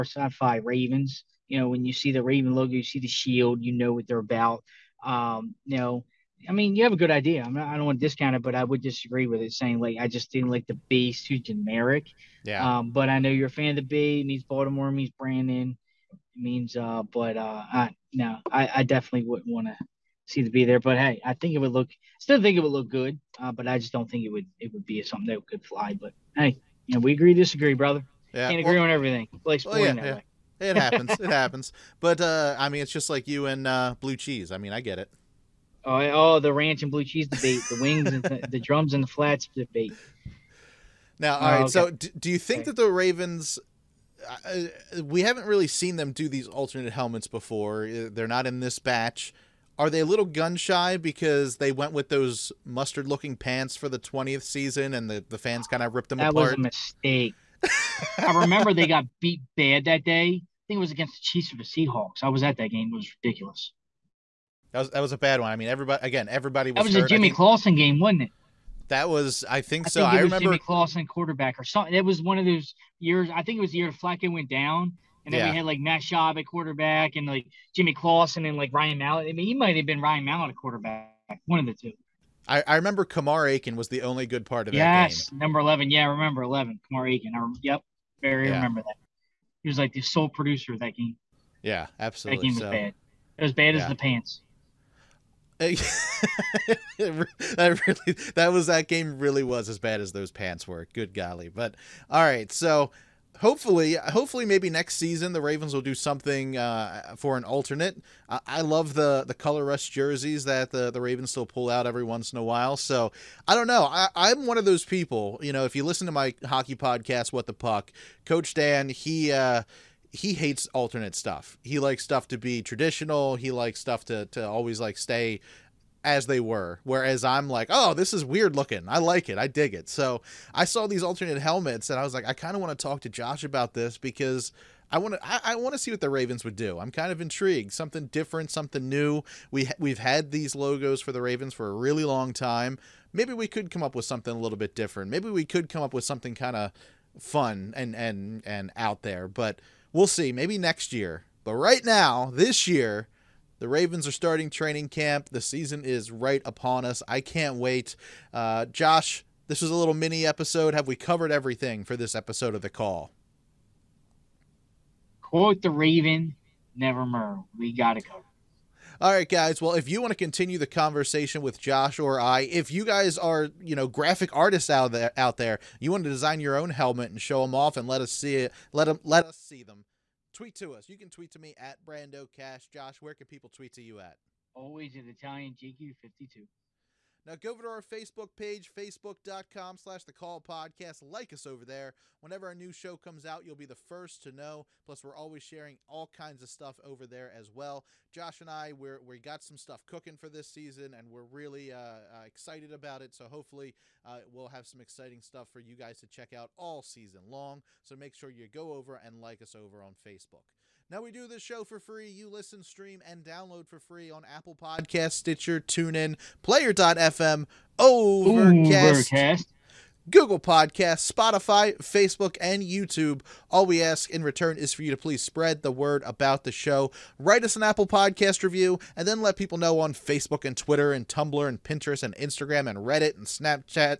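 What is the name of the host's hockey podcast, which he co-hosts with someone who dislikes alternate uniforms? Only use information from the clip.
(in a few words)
What the Puck.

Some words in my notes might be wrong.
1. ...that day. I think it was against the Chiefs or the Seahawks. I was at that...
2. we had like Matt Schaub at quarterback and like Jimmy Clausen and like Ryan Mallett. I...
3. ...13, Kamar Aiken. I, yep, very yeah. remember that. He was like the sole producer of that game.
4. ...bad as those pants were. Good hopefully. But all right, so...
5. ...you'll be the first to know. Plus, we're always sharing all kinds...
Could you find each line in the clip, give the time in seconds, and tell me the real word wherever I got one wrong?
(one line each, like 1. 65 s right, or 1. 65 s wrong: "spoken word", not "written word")
1. 59 s right
2. 75 s right
3. 86 s wrong: "11", not "13"
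4. 99 s wrong: "golly", not "hopefully"
5. 193 s right.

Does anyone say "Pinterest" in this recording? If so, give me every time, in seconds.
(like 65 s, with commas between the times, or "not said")
231 s.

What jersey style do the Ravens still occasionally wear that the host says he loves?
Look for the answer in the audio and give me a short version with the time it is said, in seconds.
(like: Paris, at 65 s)
color rush jerseys, at 109 s.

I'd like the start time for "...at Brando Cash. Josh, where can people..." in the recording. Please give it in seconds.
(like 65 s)
181 s.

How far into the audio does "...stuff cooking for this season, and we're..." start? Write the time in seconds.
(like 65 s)
199 s.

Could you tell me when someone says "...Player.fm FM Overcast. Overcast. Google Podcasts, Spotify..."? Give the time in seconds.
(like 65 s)
216 s.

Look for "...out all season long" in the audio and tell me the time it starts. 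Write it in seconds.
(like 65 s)
206 s.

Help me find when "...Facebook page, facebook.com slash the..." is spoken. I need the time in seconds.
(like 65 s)
187 s.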